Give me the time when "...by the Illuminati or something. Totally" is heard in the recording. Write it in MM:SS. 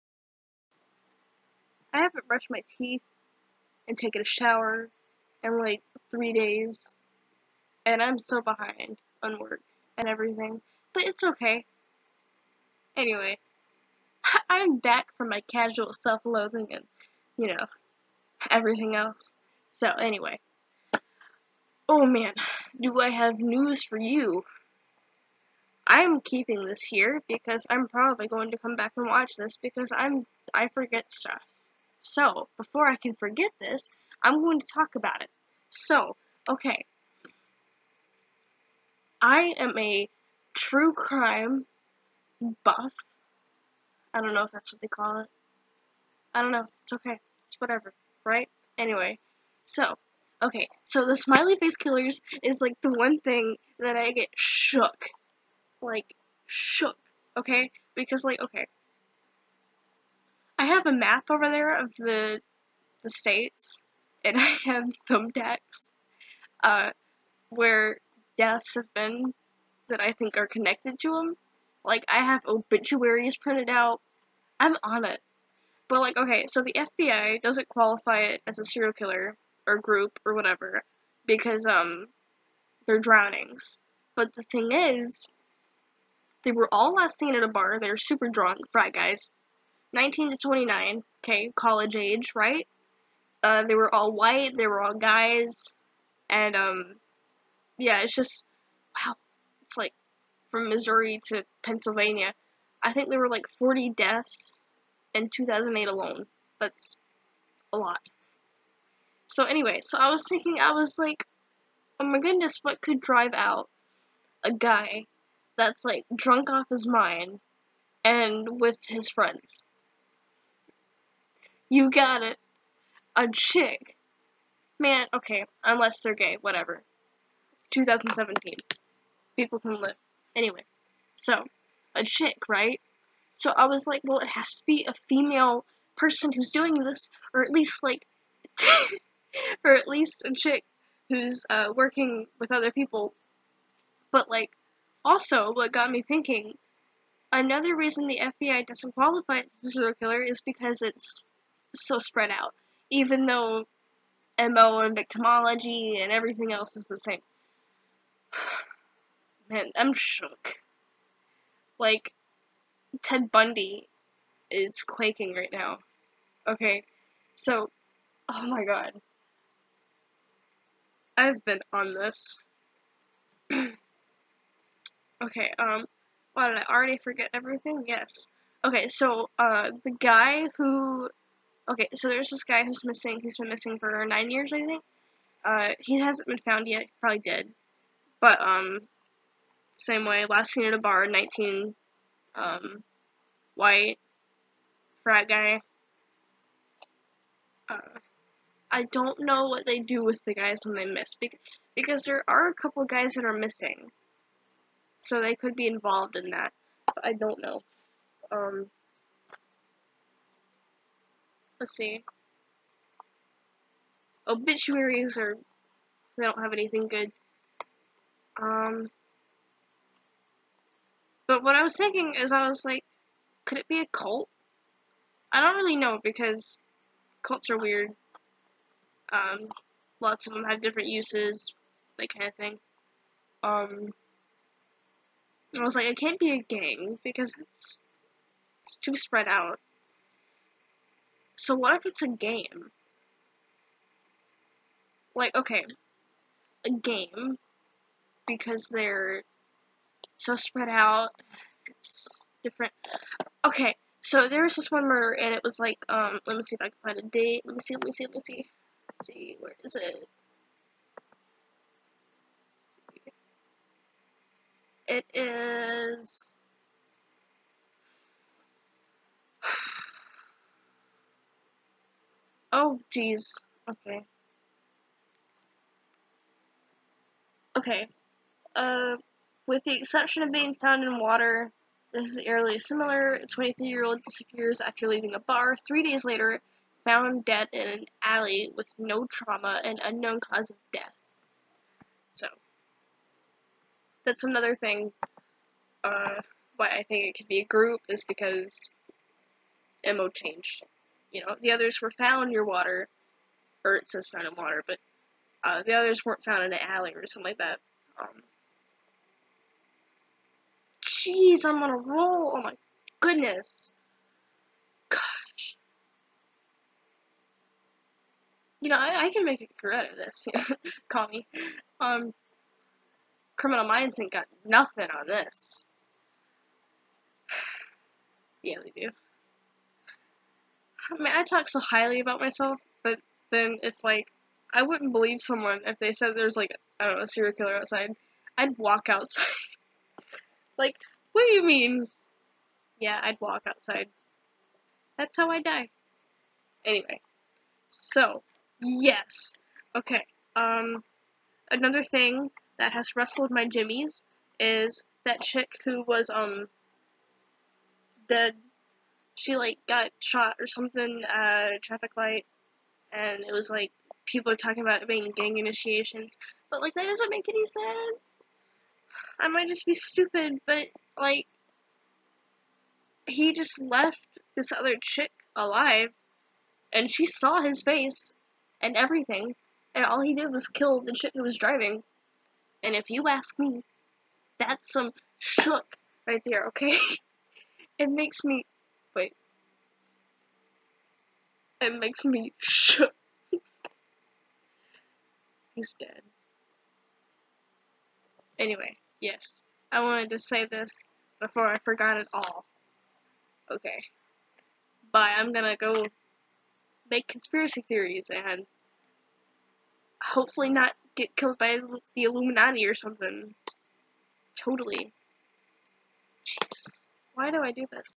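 06:51.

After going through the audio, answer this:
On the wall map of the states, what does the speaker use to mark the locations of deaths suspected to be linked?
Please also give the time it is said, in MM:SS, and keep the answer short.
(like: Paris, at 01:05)
Thumbtacks, at 01:05.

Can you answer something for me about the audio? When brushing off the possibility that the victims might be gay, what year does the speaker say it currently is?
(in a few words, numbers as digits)
2017.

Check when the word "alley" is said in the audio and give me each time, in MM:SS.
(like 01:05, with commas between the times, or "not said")
04:48, 05:06.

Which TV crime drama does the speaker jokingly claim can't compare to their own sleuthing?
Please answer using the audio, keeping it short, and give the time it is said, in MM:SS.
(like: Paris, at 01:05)
Criminal Minds, at 05:23.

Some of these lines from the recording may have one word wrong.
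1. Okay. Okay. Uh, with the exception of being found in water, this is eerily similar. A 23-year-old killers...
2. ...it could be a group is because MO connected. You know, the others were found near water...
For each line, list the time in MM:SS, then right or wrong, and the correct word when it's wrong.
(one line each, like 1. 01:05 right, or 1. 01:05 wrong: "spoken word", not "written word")
1. 04:33 wrong: "disappears", not "killers"
2. 04:57 wrong: "changed", not "connected".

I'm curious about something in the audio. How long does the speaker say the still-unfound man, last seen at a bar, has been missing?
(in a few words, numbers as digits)
9 years.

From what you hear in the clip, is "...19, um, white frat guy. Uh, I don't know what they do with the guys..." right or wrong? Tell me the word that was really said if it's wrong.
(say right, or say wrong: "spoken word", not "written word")
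right.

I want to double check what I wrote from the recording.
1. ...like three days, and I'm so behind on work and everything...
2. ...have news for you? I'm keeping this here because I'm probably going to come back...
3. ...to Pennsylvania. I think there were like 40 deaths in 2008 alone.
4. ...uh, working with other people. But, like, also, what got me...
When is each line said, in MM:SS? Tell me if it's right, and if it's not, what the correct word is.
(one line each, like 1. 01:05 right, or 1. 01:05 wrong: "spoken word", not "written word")
1. 00:05 right
2. 00:23 right
3. 01:41 right
4. 02:21 right.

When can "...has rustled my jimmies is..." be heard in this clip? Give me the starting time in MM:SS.
05:52.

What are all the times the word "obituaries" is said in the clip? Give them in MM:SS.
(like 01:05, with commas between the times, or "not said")
01:12, 03:34.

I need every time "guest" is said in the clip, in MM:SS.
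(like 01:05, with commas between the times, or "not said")
not said.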